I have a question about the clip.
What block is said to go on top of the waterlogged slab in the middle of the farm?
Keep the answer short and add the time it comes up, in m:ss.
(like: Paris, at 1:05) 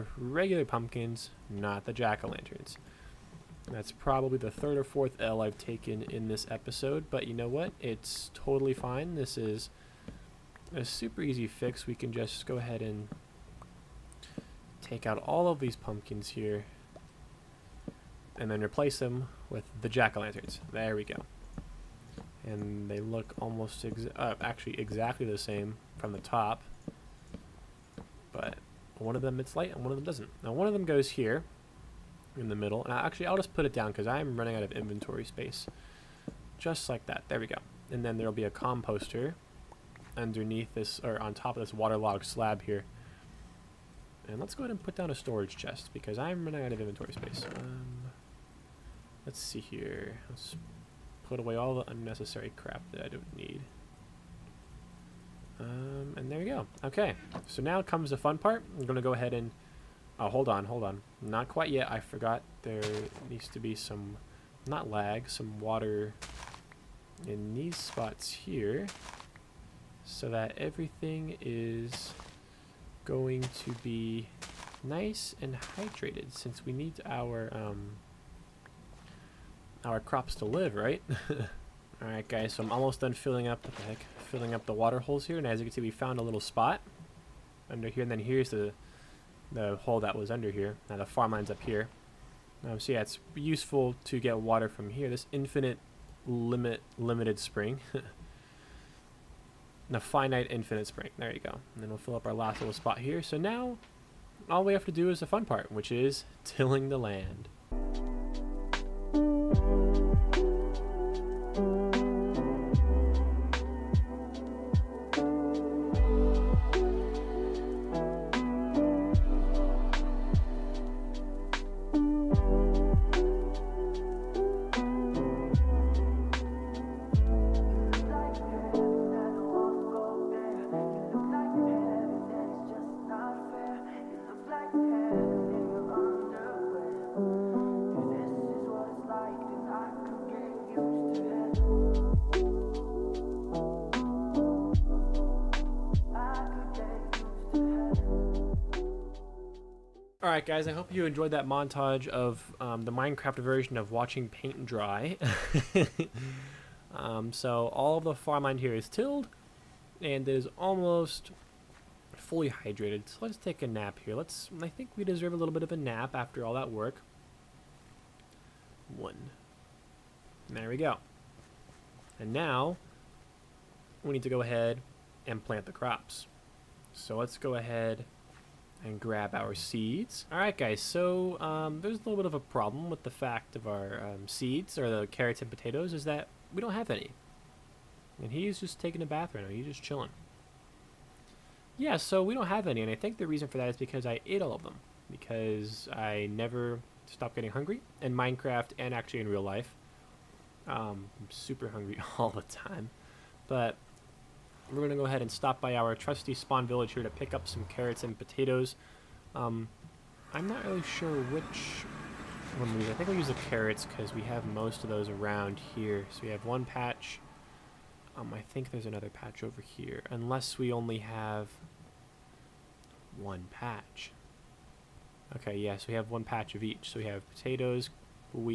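composter, at 0:38.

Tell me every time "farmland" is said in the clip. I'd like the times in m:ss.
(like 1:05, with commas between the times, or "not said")
1:31, 2:38.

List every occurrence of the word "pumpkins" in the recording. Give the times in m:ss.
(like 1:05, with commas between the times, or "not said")
0:00, 0:15.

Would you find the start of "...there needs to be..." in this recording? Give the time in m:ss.
1:02.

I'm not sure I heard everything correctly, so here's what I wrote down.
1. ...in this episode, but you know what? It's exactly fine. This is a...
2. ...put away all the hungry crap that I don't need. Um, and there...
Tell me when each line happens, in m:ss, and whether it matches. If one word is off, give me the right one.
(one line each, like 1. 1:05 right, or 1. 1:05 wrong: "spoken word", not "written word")
1. 0:06 wrong: "totally", not "exactly"
2. 0:51 wrong: "unnecessary", not "hungry".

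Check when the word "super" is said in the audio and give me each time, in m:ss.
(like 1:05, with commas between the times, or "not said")
0:10, 3:21.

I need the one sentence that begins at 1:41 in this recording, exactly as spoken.
And then we'll fill up our last little spot here.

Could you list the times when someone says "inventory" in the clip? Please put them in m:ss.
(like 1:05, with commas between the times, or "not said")
0:34, 0:46.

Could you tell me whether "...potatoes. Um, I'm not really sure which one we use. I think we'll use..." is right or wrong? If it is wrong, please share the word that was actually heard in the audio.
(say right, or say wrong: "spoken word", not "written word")
right.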